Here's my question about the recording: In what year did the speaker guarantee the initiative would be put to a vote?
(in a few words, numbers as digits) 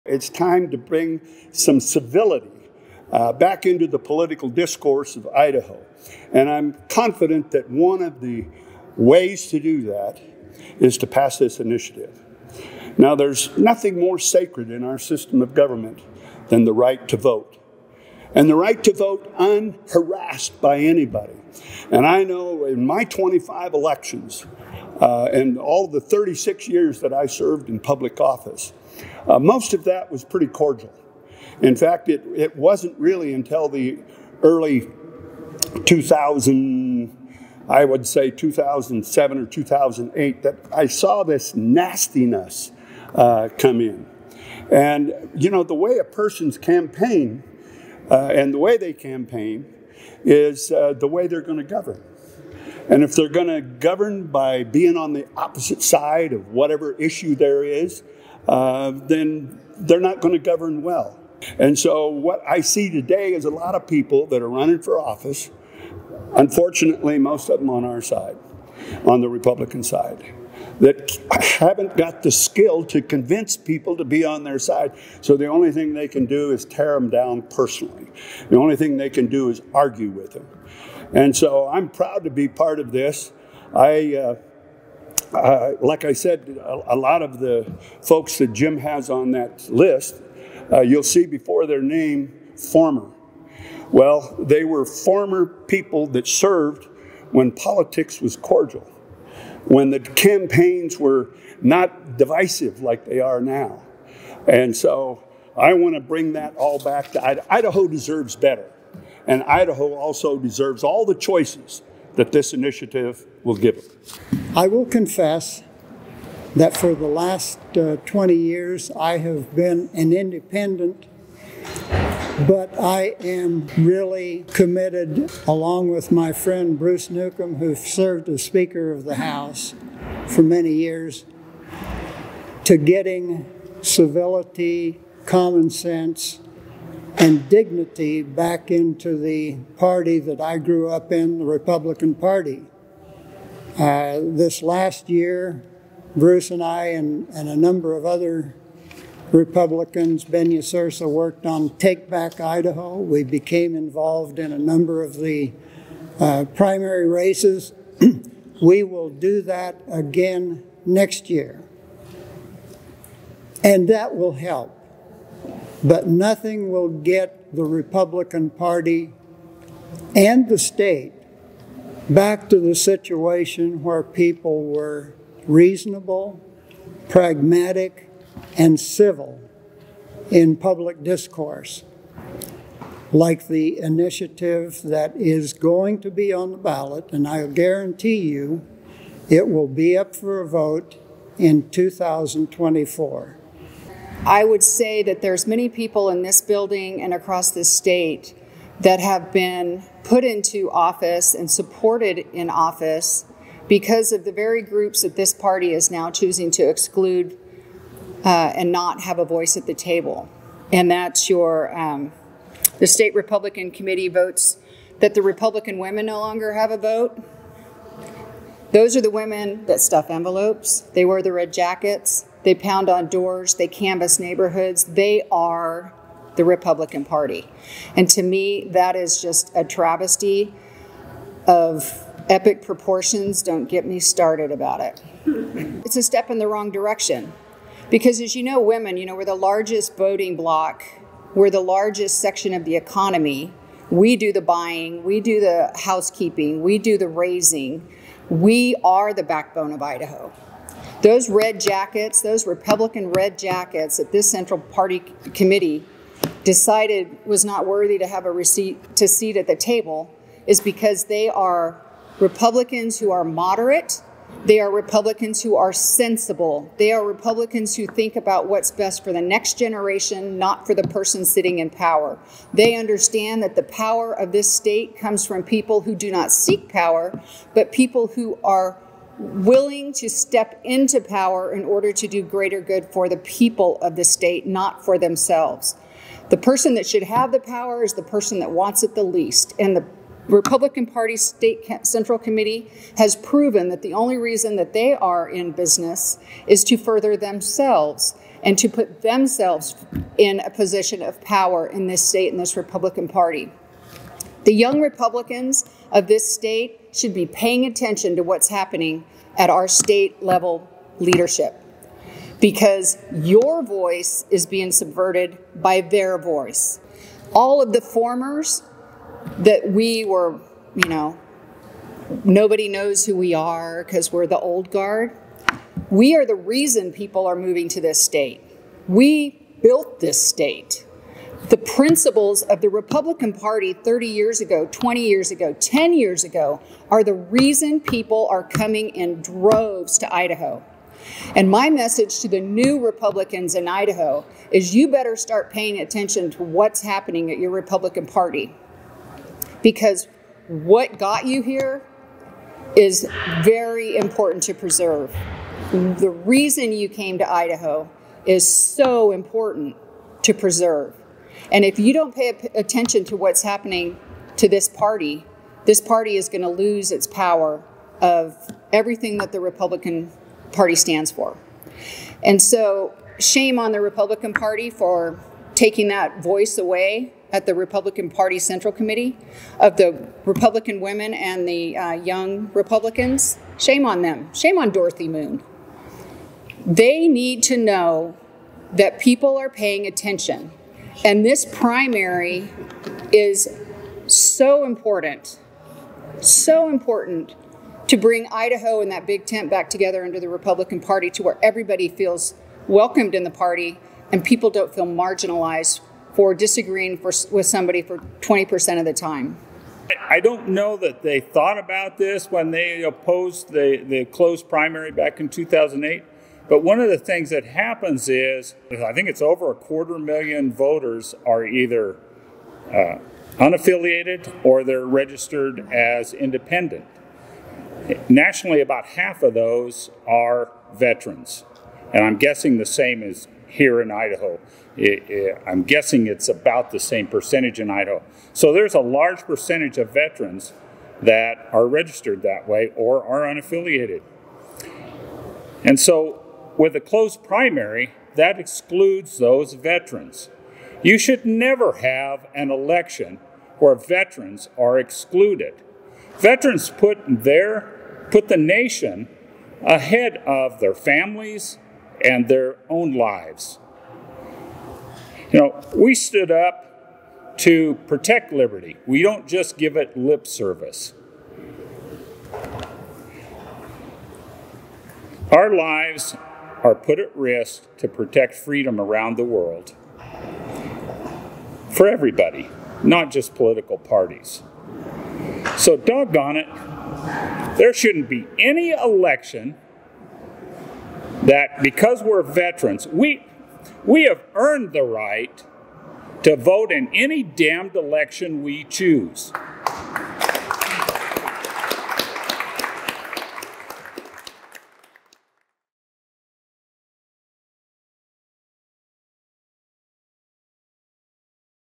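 2024.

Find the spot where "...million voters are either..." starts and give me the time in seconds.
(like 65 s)
419 s.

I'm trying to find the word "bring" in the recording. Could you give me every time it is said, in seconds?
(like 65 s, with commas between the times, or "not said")
0 s, 106 s, 397 s.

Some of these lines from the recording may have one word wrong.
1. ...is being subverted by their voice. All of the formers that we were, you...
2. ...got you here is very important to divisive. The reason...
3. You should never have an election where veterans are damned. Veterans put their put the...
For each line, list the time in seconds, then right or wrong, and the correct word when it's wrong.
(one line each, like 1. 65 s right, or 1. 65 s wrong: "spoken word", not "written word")
1. 314 s right
2. 350 s wrong: "preserve", not "divisive"
3. 450 s wrong: "excluded", not "damned".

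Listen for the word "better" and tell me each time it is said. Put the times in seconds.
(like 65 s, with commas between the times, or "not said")
108 s, 344 s.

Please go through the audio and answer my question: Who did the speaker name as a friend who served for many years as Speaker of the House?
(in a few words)
Bruce Newcomb.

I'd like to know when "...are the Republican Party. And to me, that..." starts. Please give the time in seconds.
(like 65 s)
225 s.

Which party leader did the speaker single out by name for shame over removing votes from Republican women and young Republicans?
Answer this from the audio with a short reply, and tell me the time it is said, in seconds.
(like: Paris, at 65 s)
Dorothy Moon, at 384 s.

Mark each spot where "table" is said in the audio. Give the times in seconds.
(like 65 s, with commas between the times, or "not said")
209 s, 259 s.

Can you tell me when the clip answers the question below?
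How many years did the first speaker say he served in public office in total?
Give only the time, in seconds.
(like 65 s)
26 s.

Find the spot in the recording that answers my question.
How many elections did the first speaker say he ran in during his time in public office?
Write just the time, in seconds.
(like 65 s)
23 s.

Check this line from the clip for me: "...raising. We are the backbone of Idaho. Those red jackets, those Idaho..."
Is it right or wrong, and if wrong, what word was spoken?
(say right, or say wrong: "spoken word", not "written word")
wrong: "Republican", not "Idaho".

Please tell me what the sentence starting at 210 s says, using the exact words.
And that's your, um, the state Republican committee votes that the Republican women no longer have a vote.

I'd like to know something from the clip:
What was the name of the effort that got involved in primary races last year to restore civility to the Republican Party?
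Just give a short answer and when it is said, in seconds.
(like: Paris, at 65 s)
Take Back Idaho, at 151 s.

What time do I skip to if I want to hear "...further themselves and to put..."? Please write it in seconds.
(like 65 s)
296 s.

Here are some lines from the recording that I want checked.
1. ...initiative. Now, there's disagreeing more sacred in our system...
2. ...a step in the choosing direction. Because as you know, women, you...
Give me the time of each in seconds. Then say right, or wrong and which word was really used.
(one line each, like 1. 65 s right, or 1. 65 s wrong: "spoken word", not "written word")
1. 11 s wrong: "nothing", not "disagreeing"
2. 235 s wrong: "wrong", not "choosing".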